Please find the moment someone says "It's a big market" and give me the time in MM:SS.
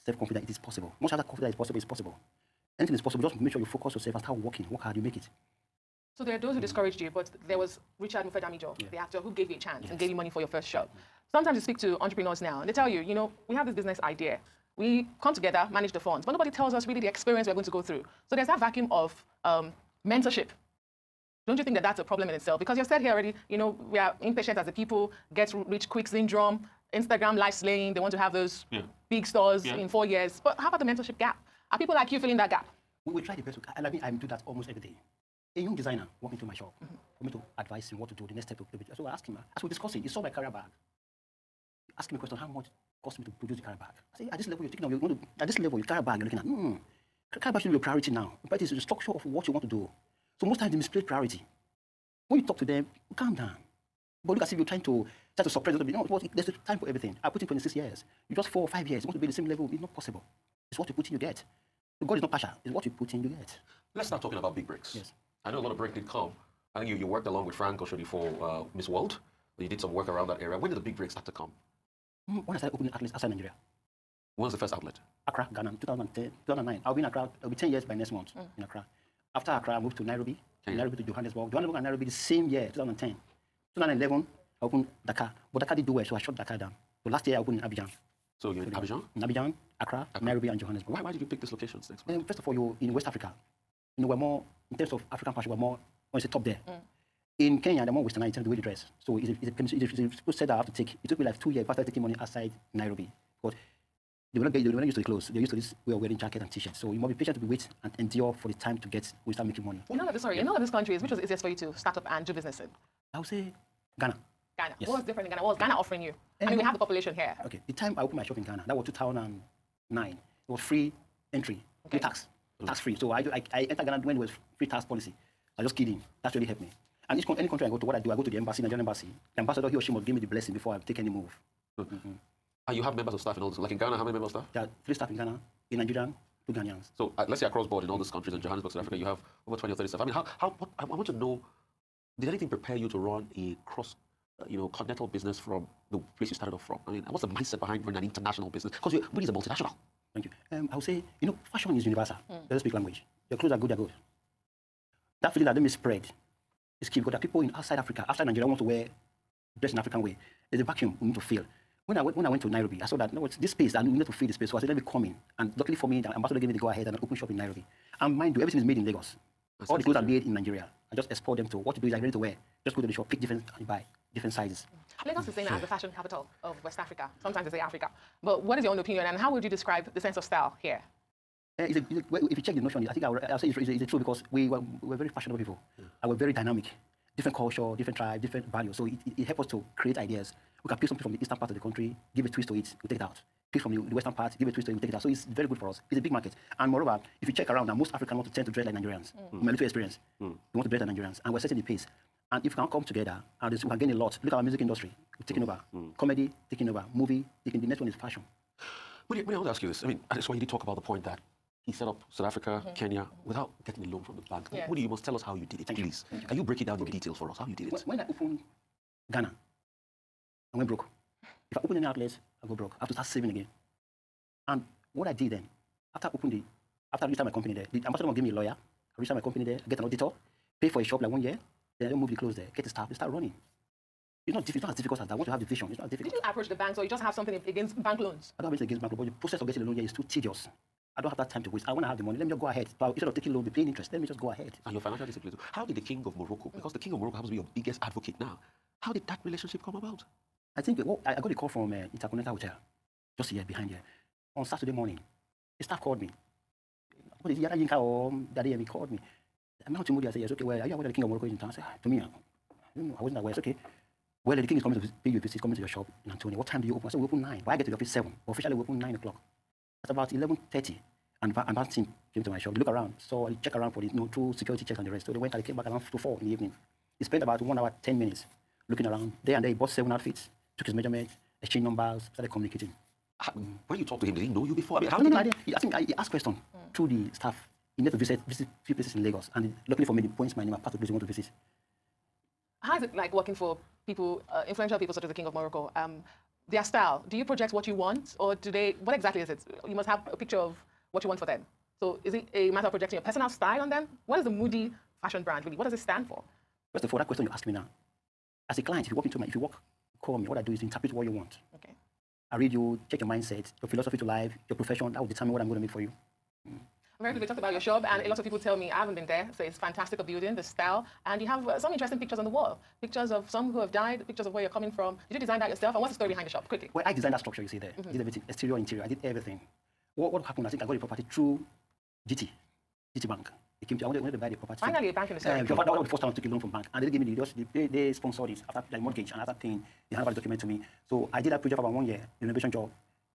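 03:15.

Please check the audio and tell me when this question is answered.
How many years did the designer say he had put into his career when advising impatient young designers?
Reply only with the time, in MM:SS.
00:57.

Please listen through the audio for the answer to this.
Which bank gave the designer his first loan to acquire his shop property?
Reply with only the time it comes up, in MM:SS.
05:32.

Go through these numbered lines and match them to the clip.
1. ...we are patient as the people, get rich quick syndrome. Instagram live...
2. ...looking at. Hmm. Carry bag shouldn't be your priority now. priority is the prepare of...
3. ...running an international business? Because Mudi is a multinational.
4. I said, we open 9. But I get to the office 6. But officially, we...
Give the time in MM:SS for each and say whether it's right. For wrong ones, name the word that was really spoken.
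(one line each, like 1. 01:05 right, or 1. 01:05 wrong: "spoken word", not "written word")
1. 00:23 wrong: "impatient", not "patient"
2. 00:46 wrong: "structure", not "prepare"
3. 02:27 right
4. 04:26 wrong: "7", not "6".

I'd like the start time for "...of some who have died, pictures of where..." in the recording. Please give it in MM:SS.
05:23.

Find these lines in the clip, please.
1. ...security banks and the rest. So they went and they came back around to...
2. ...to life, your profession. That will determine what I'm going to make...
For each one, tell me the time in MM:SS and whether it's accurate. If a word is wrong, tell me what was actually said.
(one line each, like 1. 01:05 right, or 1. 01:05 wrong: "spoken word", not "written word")
1. 04:34 wrong: "checks", not "banks"
2. 05:13 right.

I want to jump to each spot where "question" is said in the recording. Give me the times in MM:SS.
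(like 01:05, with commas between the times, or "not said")
00:42, 04:46, 05:07.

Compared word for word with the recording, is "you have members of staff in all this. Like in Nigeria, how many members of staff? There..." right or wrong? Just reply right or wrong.
wrong.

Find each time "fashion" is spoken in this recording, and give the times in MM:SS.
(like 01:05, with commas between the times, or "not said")
01:35, 02:31, 02:55, 03:28, 05:05.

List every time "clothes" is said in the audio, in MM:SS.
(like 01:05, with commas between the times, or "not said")
01:45, 02:33, 02:49, 03:52.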